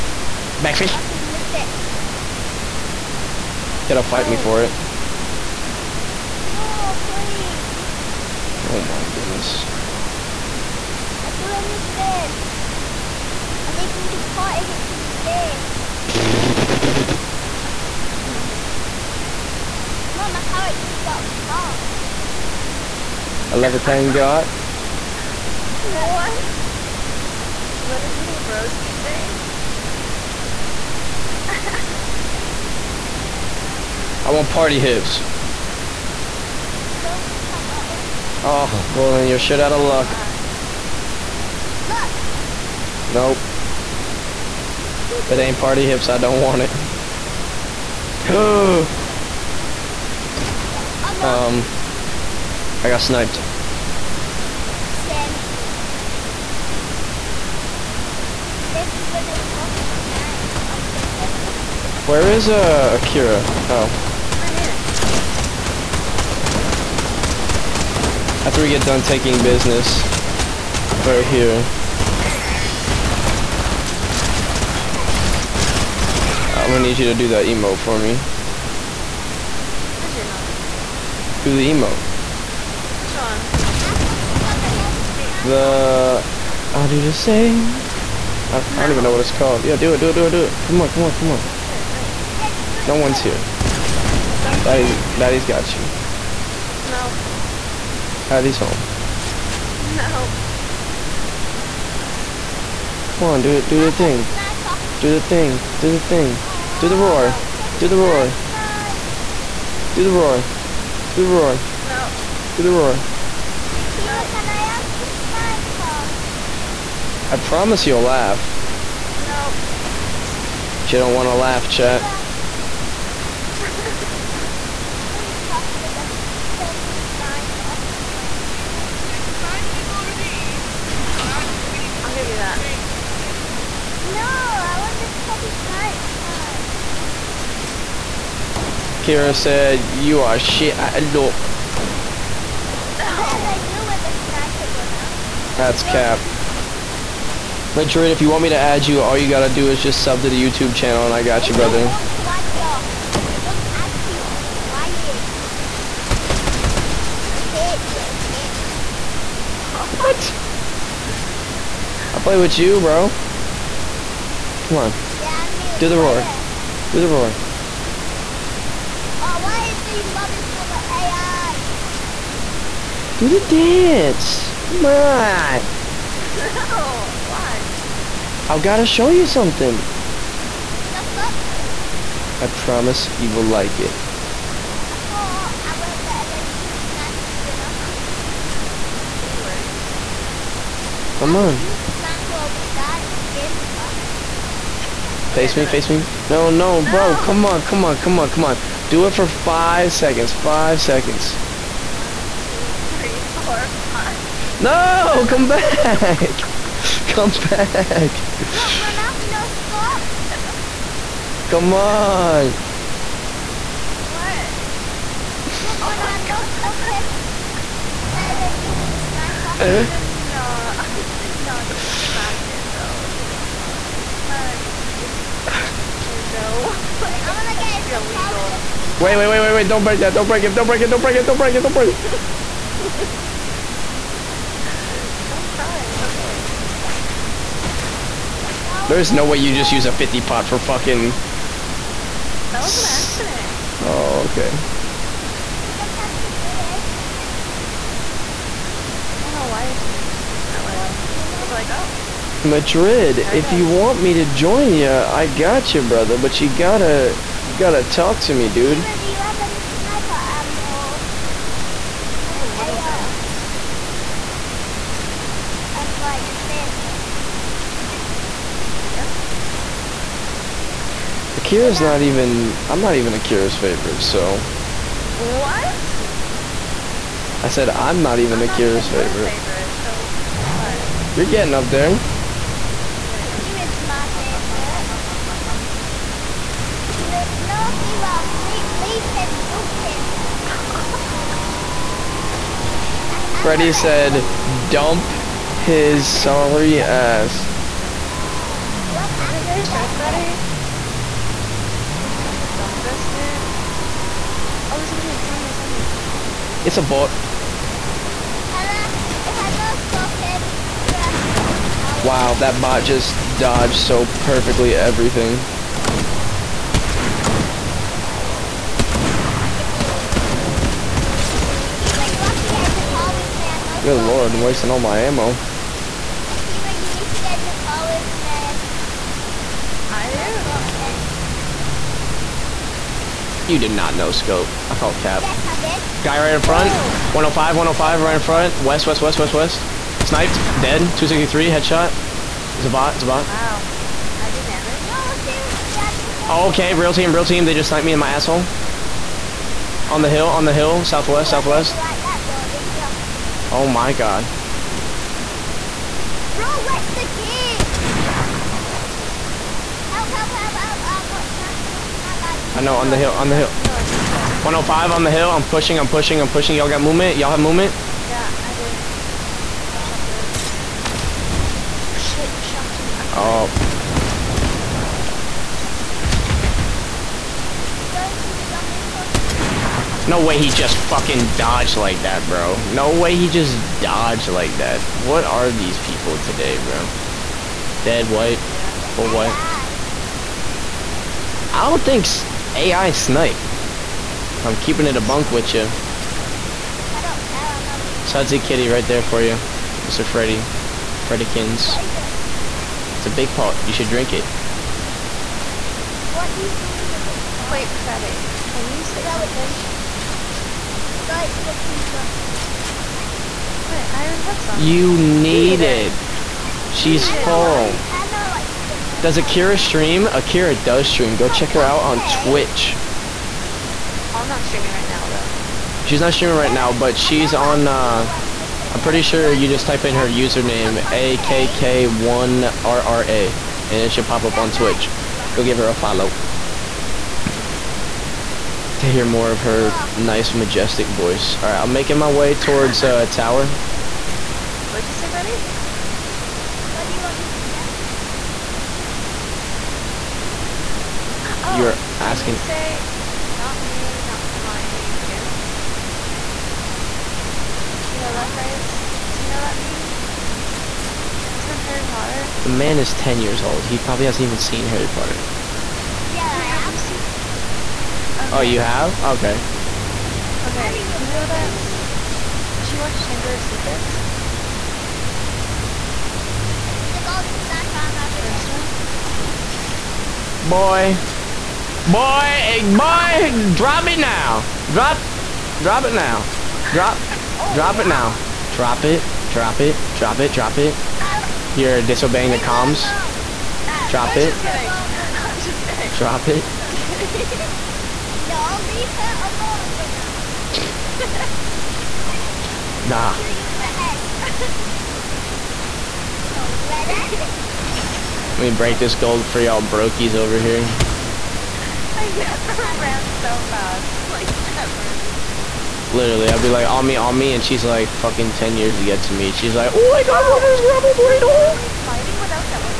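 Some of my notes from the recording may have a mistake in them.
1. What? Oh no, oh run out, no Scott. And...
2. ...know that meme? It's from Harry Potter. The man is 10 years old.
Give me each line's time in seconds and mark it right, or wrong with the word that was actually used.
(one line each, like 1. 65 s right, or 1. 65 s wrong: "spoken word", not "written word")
1. 214 s right
2. 459 s right.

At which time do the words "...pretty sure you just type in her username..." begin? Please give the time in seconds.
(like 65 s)
428 s.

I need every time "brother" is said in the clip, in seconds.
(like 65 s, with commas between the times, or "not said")
151 s, 255 s.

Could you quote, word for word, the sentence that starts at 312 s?
Wow, that bot just dodged so perfectly everything.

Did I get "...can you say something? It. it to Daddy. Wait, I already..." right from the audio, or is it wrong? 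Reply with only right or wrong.
wrong.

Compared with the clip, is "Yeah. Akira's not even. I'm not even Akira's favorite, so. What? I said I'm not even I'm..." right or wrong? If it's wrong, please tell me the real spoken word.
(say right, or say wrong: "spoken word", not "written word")
right.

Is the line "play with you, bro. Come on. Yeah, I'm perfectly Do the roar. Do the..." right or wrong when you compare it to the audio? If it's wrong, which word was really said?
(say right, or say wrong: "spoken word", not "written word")
wrong: "nearly", not "perfectly".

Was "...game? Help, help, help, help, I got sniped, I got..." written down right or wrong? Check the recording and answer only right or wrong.
right.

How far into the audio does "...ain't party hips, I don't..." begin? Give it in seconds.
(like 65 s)
45 s.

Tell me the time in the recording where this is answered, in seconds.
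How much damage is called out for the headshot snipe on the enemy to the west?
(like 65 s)
340 s.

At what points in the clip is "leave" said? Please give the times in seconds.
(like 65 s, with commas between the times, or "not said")
288 s, 498 s.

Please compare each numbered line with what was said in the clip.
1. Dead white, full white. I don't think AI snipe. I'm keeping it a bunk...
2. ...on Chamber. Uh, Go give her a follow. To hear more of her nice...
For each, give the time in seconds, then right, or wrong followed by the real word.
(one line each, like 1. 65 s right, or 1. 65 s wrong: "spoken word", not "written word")
1. 387 s right
2. 434 s wrong: "Twitch", not "Chamber".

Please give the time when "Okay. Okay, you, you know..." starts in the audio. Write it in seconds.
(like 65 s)
469 s.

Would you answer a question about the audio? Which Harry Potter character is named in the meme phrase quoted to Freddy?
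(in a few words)
Hermione.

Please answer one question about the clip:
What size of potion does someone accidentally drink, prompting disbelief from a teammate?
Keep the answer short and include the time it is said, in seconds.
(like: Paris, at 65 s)
50 pot, at 239 s.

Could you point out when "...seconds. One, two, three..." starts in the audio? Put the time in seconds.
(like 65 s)
200 s.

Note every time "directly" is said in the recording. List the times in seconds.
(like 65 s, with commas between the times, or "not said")
not said.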